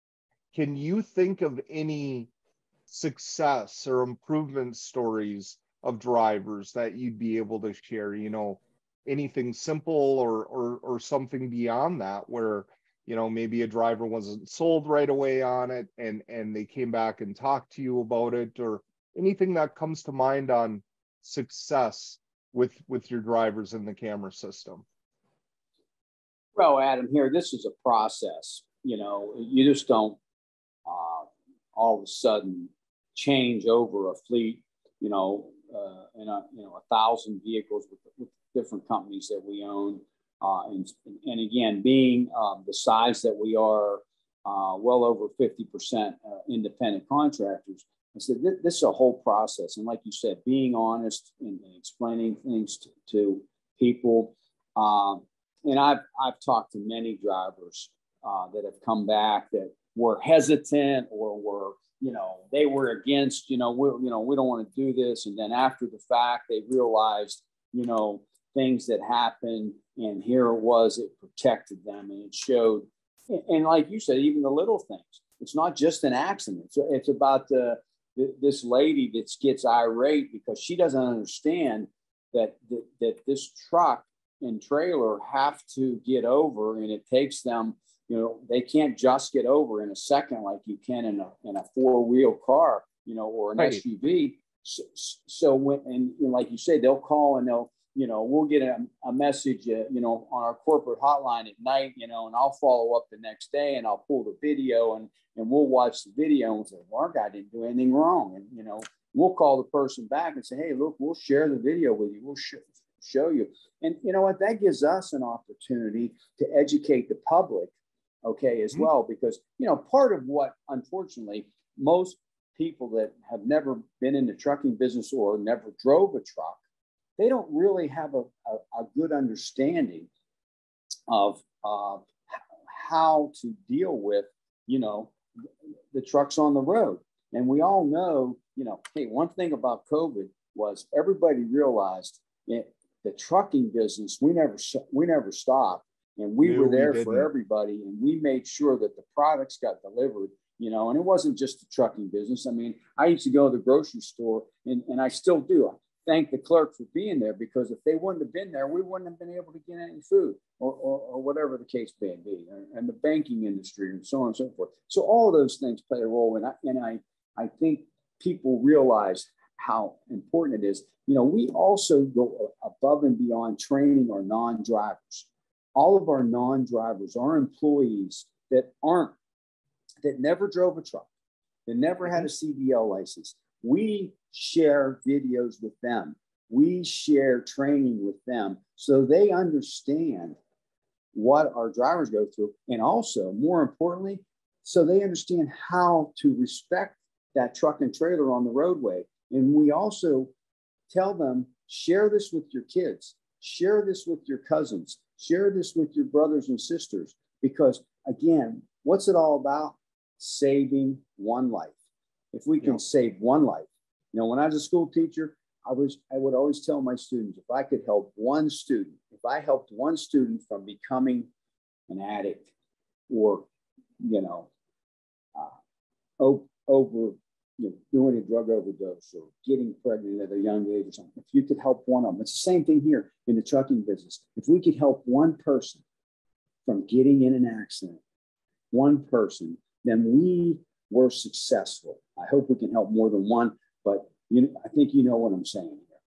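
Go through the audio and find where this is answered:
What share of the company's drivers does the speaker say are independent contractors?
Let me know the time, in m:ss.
0:44.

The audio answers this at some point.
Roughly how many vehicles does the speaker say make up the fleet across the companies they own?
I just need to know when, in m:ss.
0:36.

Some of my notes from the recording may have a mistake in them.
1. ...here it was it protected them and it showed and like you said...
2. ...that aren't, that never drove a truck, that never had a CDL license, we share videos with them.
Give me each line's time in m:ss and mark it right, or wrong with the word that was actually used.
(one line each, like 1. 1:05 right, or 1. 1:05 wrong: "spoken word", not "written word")
1. 1:10 right
2. 2:58 right.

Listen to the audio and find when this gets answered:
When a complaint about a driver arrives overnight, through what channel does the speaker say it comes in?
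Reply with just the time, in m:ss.
1:40.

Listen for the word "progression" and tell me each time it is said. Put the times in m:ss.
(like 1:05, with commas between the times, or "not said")
not said.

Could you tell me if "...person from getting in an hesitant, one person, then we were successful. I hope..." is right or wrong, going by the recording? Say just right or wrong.
wrong.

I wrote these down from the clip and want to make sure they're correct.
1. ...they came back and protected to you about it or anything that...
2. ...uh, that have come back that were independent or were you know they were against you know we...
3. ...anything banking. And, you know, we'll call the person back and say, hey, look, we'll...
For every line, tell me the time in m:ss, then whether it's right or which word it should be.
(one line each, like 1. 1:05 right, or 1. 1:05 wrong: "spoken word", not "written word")
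1. 0:16 wrong: "talked", not "protected"
2. 0:58 wrong: "hesitant", not "independent"
3. 1:47 wrong: "wrong", not "banking".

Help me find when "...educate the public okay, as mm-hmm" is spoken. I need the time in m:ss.
1:56.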